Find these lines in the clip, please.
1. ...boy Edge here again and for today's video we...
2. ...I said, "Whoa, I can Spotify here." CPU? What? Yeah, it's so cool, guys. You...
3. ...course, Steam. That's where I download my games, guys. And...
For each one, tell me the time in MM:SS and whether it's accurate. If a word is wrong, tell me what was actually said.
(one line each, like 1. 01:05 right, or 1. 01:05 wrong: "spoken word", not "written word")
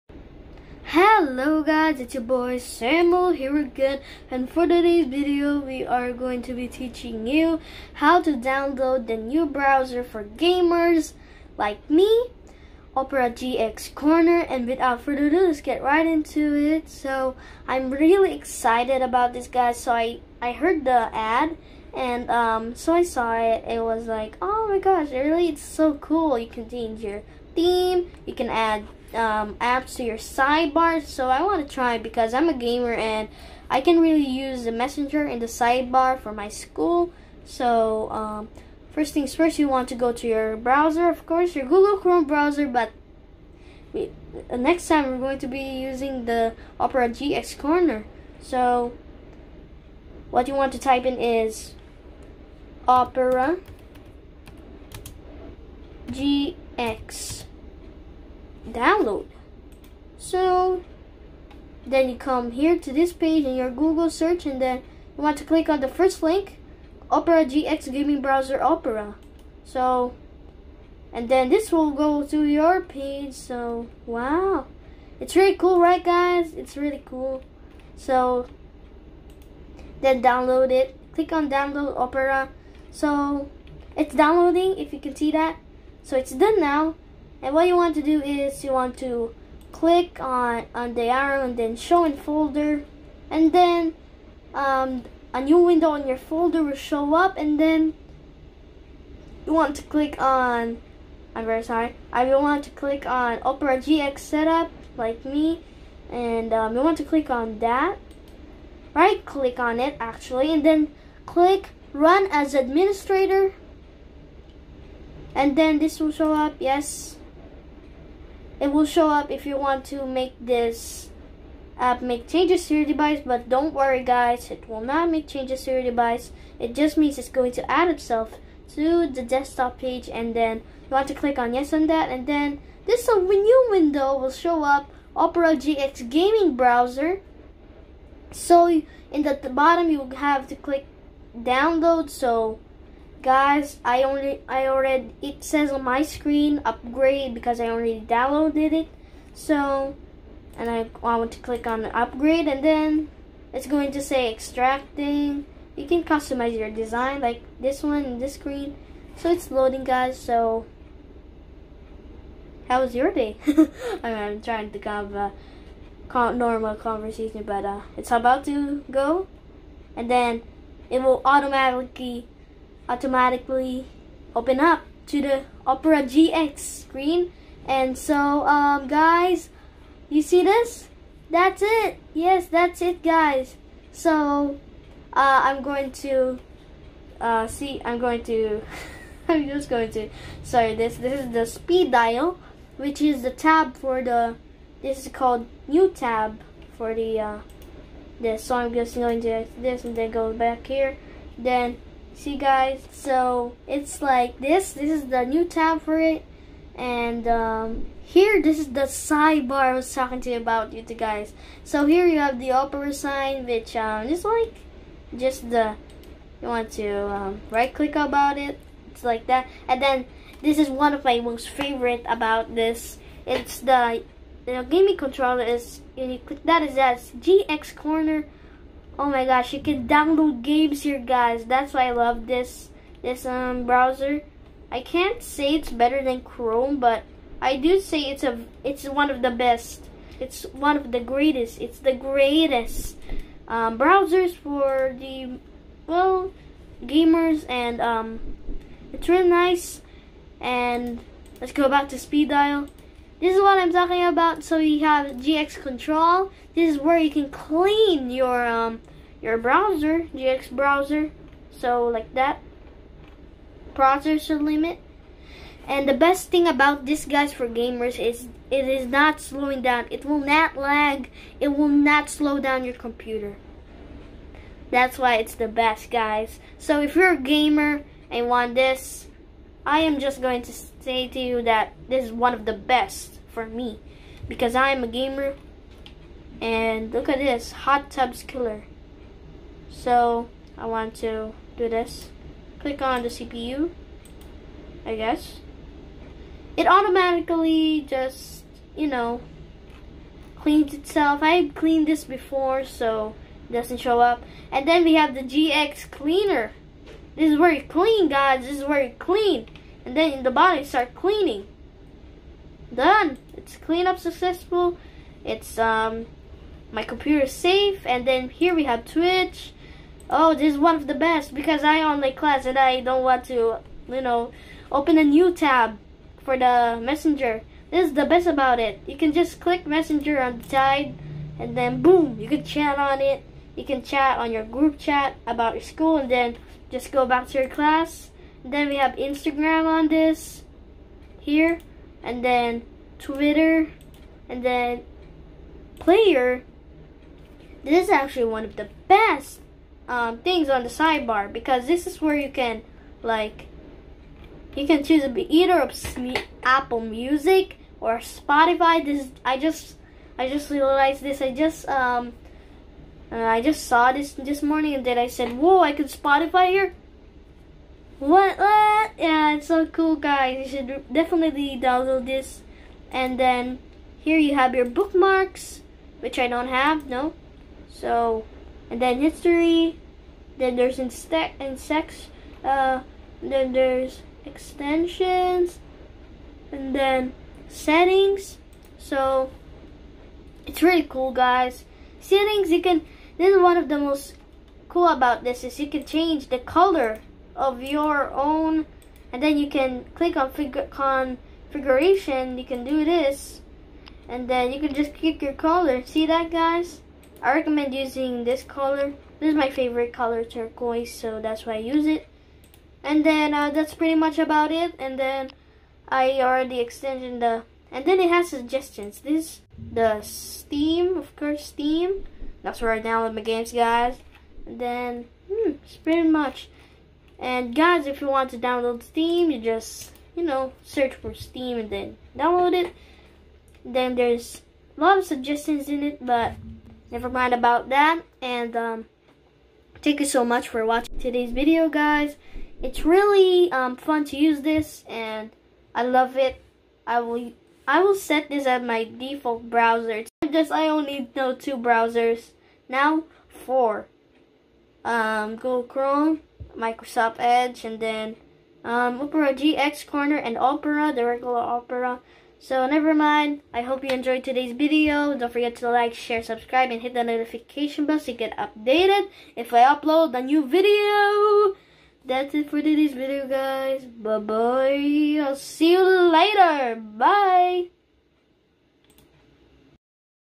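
1. 00:02 wrong: "Samuel", not "Edge"
2. 06:04 wrong: "What", not "CPU"
3. 07:01 right.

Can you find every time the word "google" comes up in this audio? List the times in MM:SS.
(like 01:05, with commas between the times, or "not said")
00:41, 01:03, 07:35.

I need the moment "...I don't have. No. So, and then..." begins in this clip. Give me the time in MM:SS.
06:16.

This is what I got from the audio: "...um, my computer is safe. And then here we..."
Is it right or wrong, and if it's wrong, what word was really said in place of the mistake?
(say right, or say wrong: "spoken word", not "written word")
right.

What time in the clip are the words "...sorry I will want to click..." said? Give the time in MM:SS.
01:41.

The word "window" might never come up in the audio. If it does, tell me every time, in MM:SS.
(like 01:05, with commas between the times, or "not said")
01:35, 02:13.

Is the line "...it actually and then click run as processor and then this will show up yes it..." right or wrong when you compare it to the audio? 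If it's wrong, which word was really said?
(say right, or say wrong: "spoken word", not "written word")
wrong: "administrator", not "processor".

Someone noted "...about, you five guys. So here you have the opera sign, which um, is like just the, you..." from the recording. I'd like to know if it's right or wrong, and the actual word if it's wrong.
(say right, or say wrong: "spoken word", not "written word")
wrong: "two", not "five".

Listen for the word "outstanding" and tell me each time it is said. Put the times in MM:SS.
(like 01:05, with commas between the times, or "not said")
not said.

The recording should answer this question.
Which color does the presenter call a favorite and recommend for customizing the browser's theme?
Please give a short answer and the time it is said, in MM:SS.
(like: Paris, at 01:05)
Turquoise, at 06:50.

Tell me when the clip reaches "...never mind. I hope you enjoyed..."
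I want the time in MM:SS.
07:42.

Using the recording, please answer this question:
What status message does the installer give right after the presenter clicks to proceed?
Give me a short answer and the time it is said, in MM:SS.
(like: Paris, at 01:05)
Extracting, at 02:34.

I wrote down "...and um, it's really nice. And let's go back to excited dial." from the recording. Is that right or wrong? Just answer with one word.
wrong.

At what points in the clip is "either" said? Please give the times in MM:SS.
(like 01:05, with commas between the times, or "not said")
05:55.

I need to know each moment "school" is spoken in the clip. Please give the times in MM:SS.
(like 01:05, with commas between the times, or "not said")
00:36, 05:35.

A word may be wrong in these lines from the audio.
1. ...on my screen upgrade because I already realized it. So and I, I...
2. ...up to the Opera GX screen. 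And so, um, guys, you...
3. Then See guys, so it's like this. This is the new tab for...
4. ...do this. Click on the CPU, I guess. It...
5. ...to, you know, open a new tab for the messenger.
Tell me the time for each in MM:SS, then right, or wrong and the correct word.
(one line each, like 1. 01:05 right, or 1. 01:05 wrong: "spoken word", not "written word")
1. 02:25 wrong: "downloaded", not "realized"
2. 02:54 right
3. 03:21 right
4. 04:51 right
5. 05:23 right.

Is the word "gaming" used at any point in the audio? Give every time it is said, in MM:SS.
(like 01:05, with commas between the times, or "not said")
01:07, 02:16, 03:44.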